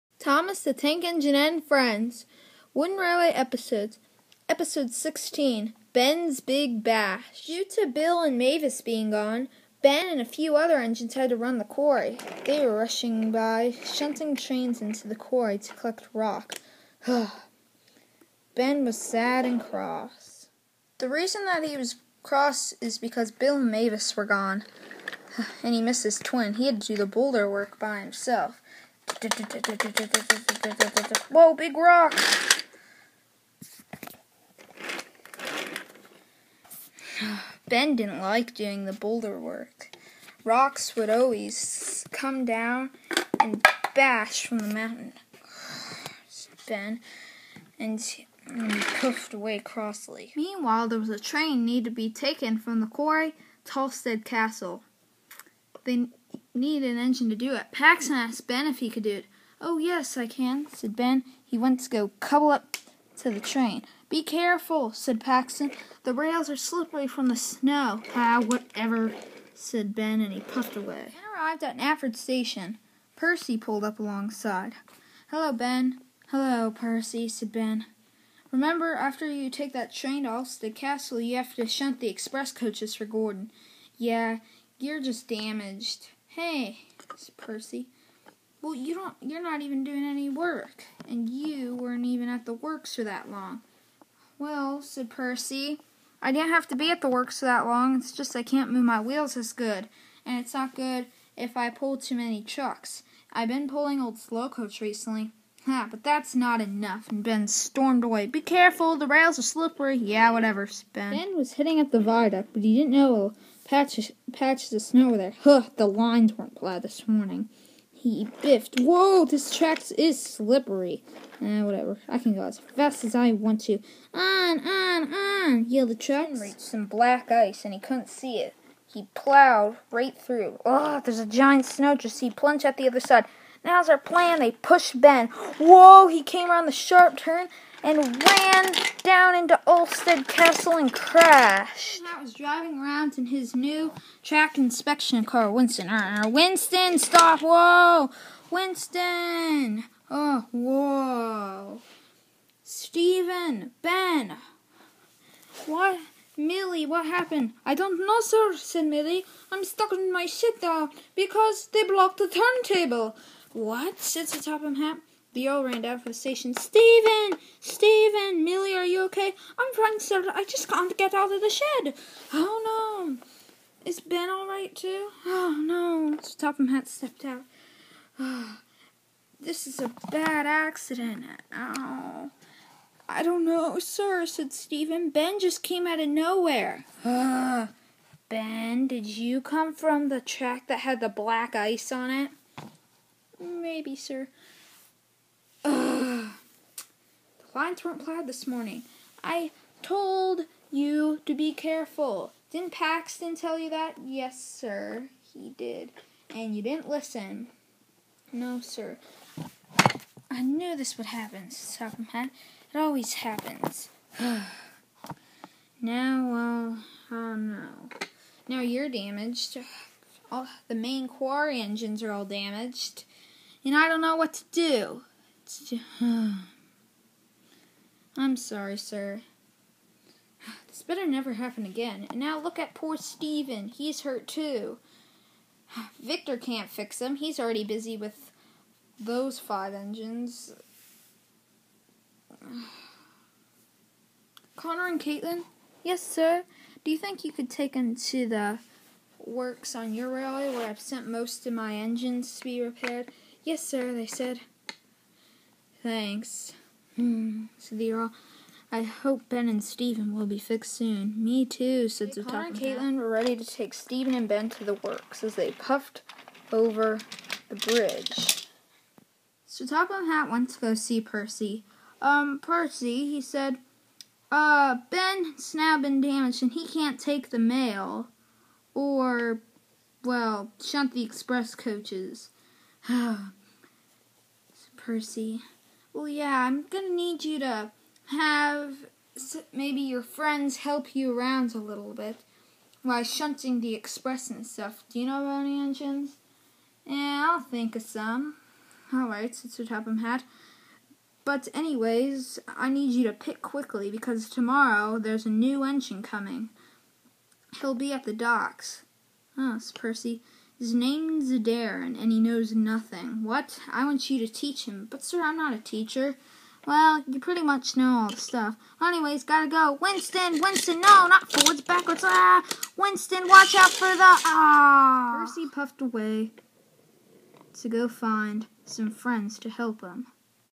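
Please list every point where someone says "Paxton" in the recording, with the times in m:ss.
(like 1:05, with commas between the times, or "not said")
0:57, 1:05, 3:22.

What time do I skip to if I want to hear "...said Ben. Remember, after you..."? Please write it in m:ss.
1:17.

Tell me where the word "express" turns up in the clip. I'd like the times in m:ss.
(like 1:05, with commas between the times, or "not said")
1:22, 4:41, 4:53.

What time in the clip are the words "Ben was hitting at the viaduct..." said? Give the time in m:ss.
1:51.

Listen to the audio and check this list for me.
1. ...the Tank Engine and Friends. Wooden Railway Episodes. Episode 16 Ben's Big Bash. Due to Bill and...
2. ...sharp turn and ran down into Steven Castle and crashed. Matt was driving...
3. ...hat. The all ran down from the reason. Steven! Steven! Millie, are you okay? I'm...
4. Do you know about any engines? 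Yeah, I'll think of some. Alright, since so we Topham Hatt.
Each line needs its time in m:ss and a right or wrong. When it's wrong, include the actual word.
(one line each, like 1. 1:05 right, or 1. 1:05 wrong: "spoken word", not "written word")
1. 0:00 right
2. 2:16 wrong: "Ulfstead", not "Steven"
3. 2:44 wrong: "station", not "reason"
4. 4:54 right.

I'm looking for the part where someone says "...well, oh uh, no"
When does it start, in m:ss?
3:35.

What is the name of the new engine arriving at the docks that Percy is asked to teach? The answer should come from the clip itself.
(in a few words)
Darren.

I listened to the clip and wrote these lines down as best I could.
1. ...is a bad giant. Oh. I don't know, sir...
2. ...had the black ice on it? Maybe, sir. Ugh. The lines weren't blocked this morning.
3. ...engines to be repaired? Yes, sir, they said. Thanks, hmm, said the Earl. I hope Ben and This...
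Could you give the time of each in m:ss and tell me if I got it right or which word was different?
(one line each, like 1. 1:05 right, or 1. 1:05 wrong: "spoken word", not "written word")
1. 2:59 wrong: "accident", not "giant"
2. 3:10 wrong: "plowed", not "blocked"
3. 4:11 wrong: "Stephen", not "This".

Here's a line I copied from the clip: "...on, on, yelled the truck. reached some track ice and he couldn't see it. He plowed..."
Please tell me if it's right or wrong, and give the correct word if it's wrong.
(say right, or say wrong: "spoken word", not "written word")
wrong: "black", not "track".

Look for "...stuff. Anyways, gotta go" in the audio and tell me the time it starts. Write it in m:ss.
5:18.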